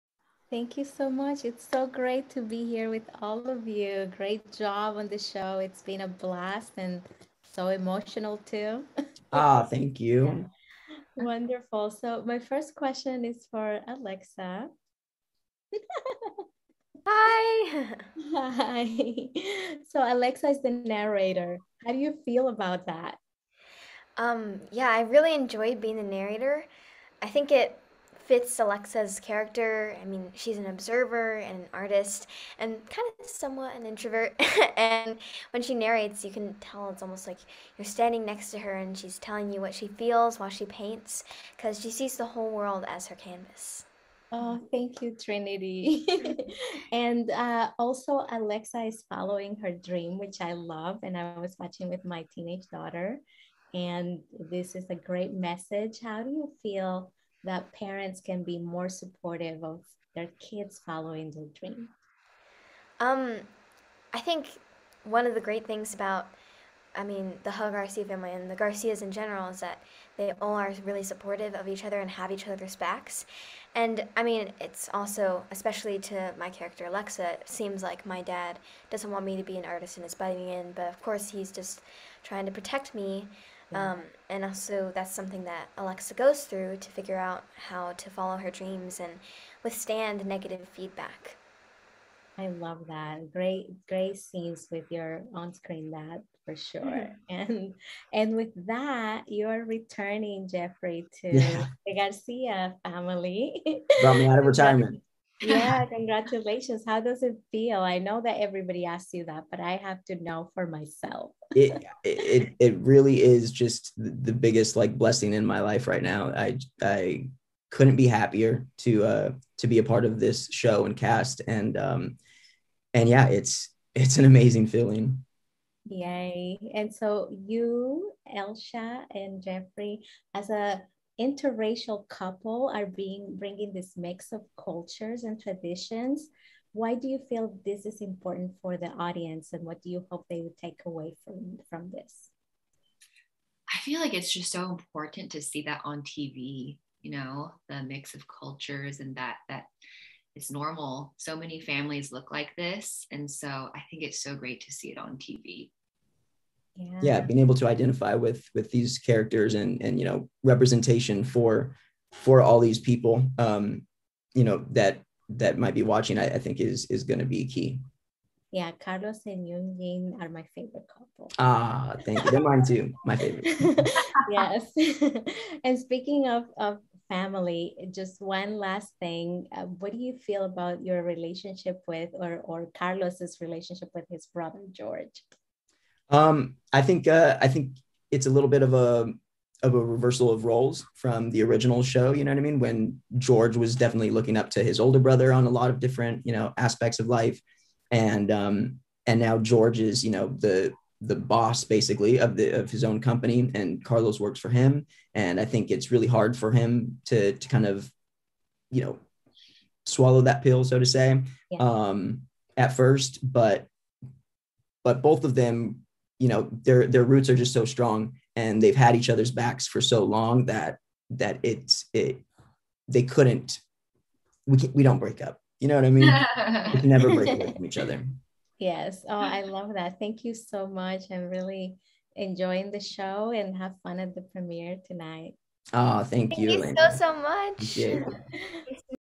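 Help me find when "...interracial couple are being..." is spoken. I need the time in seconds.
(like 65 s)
131 s.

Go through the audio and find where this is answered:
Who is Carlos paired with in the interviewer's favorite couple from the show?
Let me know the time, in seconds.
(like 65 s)
169 s.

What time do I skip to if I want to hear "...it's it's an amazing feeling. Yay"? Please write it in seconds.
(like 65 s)
123 s.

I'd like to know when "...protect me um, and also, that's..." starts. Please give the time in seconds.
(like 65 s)
82 s.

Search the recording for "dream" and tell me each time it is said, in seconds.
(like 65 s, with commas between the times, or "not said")
49 s, 61 s, 88 s.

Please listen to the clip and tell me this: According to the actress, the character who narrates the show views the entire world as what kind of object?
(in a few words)
Her canvas.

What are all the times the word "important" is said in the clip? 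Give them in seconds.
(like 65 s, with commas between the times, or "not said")
138 s, 144 s.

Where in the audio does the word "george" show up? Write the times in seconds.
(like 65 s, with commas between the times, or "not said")
184 s, 193 s, 199 s.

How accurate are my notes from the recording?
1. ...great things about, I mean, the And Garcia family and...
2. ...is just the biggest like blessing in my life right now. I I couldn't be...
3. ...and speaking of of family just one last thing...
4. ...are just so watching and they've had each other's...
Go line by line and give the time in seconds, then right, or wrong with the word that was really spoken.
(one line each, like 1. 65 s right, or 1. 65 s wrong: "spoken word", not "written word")
1. 65 s wrong: "Huh", not "And"
2. 113 s right
3. 175 s right
4. 217 s wrong: "strong", not "watching".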